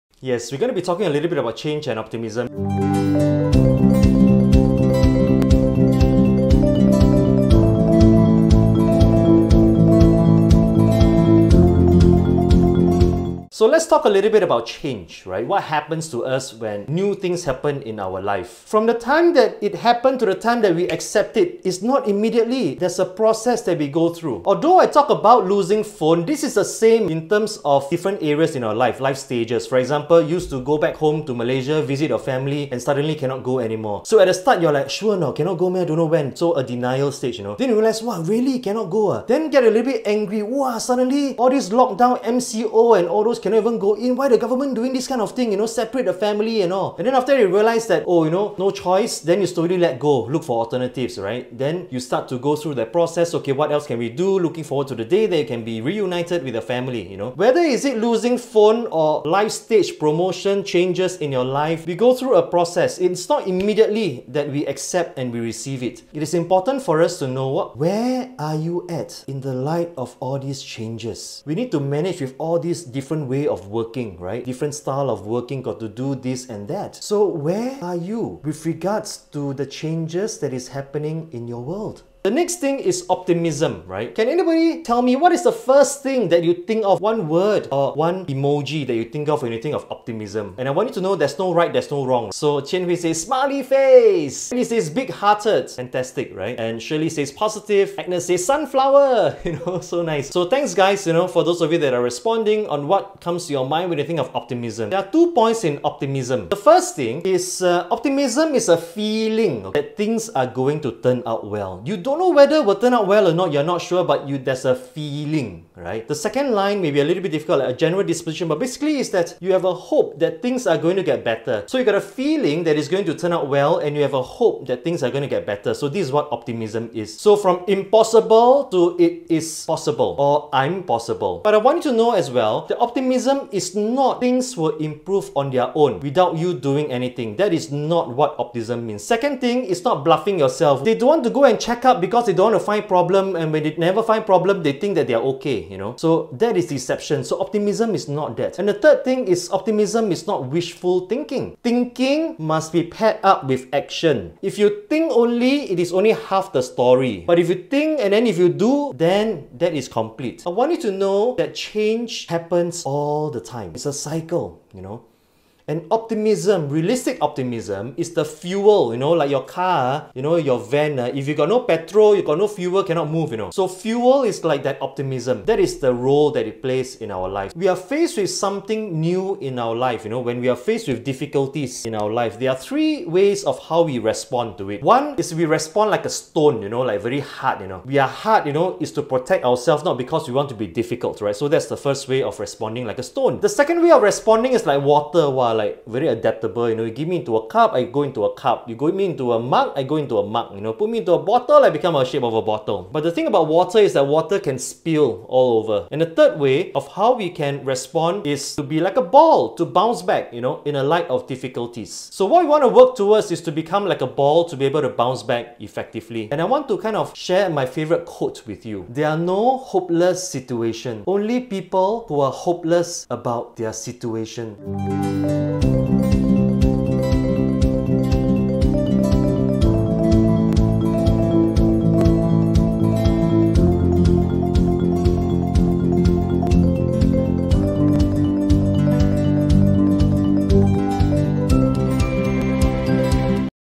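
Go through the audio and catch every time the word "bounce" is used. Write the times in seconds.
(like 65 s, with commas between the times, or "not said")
209 s, 214 s.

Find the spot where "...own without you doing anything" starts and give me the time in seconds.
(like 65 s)
135 s.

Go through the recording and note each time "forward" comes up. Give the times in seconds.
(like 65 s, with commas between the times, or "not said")
54 s.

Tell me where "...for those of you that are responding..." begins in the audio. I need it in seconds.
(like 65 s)
101 s.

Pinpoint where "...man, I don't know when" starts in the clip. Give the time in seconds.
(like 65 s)
35 s.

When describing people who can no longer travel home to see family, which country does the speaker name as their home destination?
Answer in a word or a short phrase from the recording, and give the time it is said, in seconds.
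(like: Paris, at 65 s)
Malaysia, at 31 s.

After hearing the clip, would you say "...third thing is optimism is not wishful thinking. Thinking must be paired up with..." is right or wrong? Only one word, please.
right.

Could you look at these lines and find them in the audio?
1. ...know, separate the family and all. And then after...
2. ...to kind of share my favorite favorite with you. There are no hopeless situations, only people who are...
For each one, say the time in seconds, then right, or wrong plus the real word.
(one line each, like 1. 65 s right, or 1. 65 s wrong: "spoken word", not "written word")
1. 45 s right
2. 216 s wrong: "quote", not "favorite".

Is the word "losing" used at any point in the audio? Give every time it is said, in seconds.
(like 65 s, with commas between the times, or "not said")
25 s, 57 s.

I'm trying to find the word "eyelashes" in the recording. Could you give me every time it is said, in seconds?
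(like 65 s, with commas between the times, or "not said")
not said.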